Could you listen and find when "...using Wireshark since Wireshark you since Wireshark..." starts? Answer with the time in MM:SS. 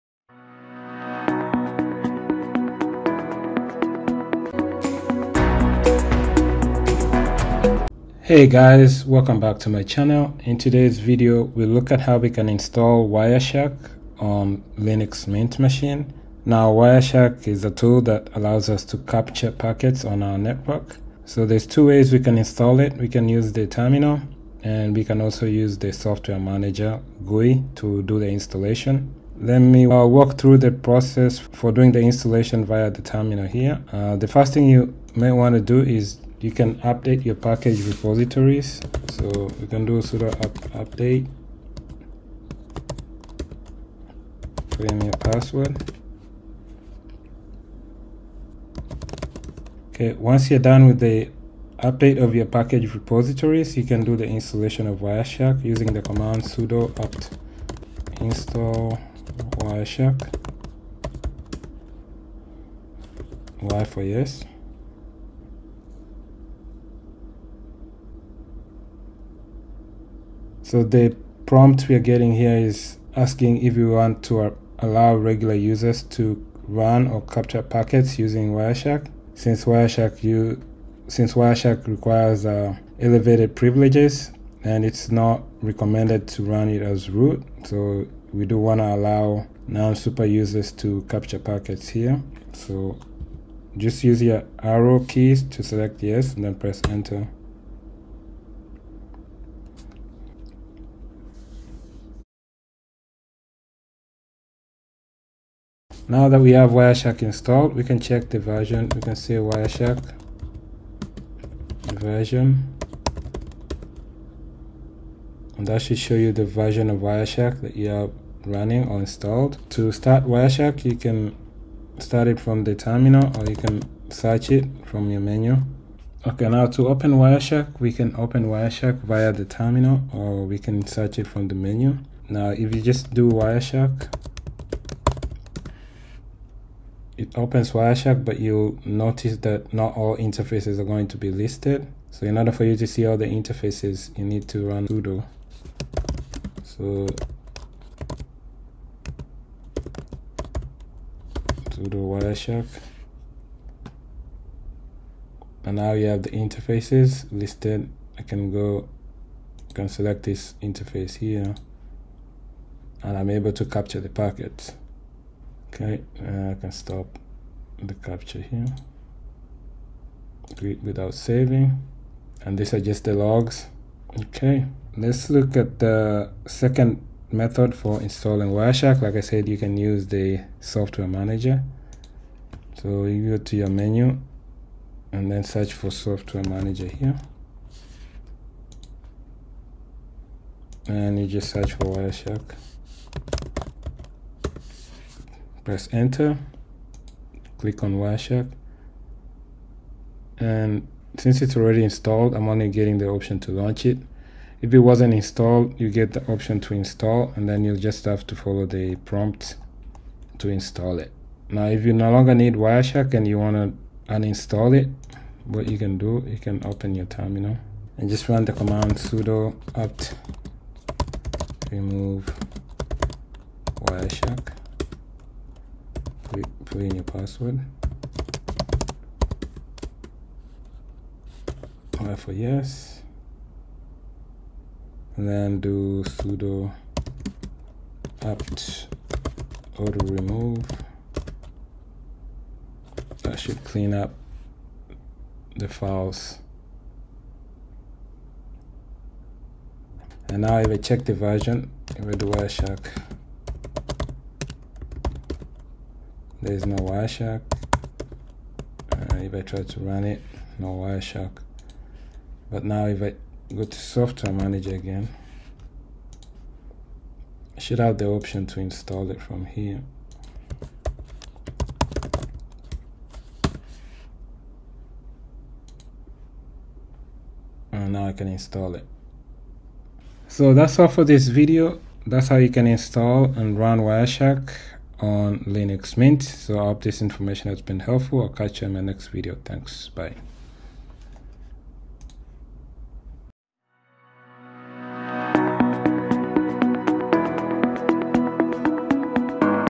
01:18.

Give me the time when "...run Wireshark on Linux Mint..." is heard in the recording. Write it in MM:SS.
04:43.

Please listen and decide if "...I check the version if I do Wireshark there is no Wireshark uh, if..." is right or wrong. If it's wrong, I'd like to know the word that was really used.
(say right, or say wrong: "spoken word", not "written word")
right.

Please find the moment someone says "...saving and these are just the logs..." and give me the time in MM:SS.
02:51.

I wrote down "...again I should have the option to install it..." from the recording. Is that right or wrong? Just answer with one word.
right.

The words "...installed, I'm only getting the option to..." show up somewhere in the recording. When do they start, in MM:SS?
03:21.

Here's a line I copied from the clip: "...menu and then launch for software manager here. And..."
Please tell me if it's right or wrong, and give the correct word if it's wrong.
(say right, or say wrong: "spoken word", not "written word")
wrong: "search", not "launch".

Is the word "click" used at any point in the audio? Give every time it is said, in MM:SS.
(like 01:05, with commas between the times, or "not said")
03:17.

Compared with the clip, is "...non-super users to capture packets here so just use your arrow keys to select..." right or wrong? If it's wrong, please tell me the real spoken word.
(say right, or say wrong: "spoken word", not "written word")
right.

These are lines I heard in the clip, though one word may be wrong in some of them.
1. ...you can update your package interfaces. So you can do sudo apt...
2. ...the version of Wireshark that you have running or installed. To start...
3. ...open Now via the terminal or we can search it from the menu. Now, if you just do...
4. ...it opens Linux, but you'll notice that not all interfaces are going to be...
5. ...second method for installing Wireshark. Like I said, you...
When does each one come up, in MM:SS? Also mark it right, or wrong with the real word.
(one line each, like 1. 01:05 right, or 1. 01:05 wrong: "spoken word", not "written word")
1. 00:36 wrong: "repositories", not "interfaces"
2. 01:56 right
3. 02:08 wrong: "Wireshark", not "Now"
4. 02:17 wrong: "Wireshark", not "Linux"
5. 02:56 right.